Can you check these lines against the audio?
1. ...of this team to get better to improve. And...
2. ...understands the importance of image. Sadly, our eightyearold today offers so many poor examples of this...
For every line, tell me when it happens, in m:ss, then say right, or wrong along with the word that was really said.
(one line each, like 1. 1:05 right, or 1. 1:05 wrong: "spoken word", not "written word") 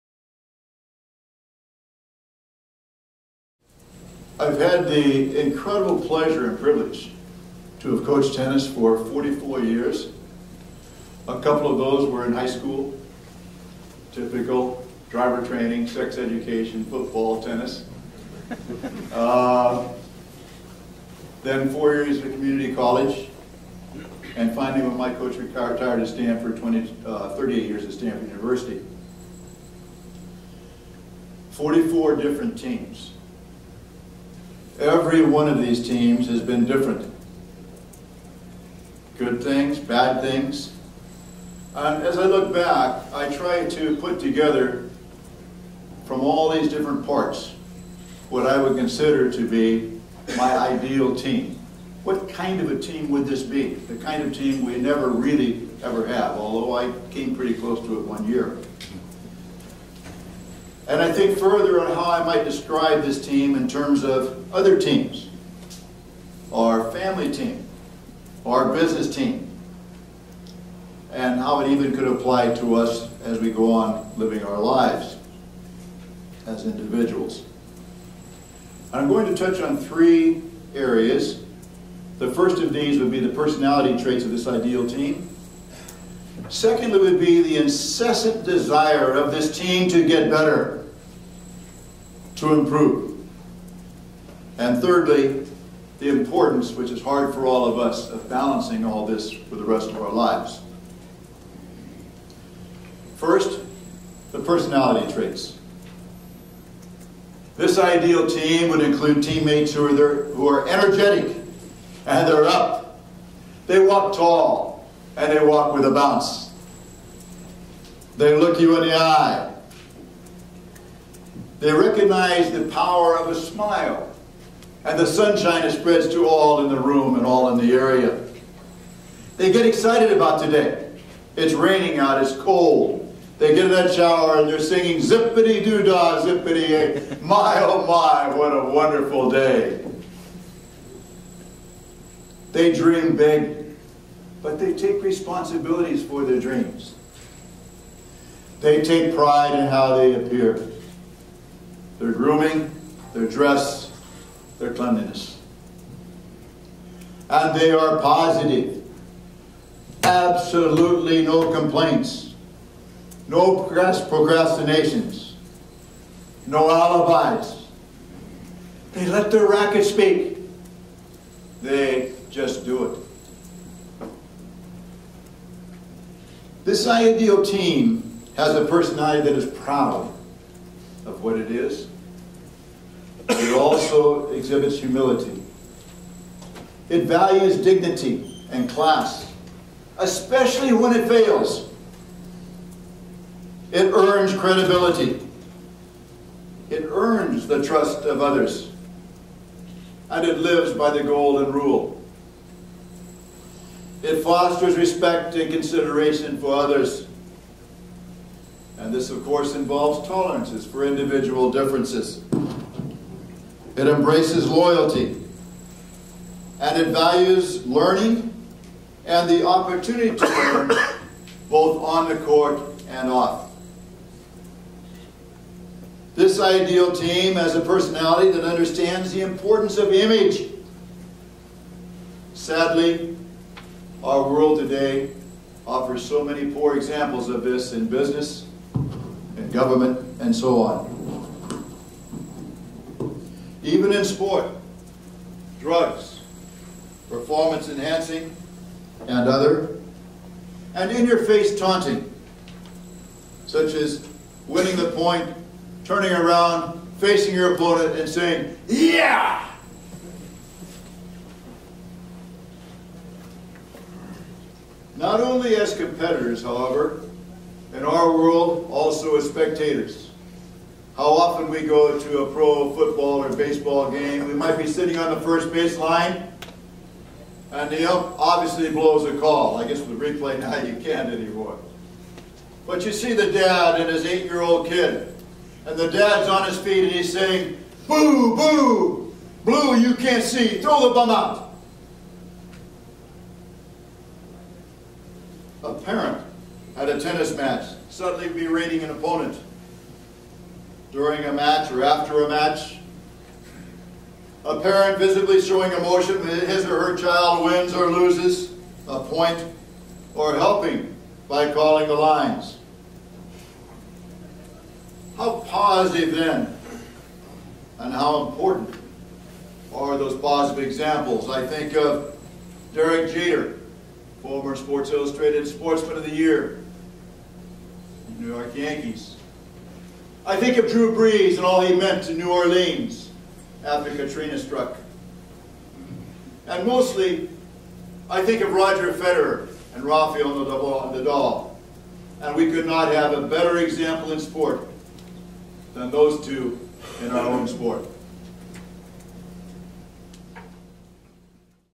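1. 1:29 right
2. 3:48 wrong: "world", not "eightyearold".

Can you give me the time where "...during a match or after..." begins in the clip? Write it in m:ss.
5:00.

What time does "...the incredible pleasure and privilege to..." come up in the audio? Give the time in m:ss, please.
0:04.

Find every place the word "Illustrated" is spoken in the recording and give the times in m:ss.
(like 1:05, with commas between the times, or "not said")
5:24.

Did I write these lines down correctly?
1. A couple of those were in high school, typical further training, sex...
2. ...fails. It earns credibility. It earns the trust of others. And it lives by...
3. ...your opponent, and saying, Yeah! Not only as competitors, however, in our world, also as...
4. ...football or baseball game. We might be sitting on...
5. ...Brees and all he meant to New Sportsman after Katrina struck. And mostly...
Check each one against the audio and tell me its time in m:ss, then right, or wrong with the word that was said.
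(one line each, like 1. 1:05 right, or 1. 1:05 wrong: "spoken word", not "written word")
1. 0:11 wrong: "driver", not "further"
2. 3:11 right
3. 4:17 right
4. 4:32 right
5. 5:30 wrong: "Orleans", not "Sportsman".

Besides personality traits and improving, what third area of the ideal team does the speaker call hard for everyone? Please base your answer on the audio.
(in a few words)
balancing.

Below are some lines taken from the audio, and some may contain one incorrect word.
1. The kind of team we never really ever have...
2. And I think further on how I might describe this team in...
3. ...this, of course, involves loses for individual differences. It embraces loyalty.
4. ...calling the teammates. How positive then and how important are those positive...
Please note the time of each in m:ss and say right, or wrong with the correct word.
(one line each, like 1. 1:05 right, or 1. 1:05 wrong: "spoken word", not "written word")
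1. 0:53 right
2. 1:00 right
3. 3:28 wrong: "tolerances", not "loses"
4. 5:11 wrong: "lines", not "teammates".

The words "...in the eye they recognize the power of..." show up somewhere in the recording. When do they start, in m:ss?
1:58.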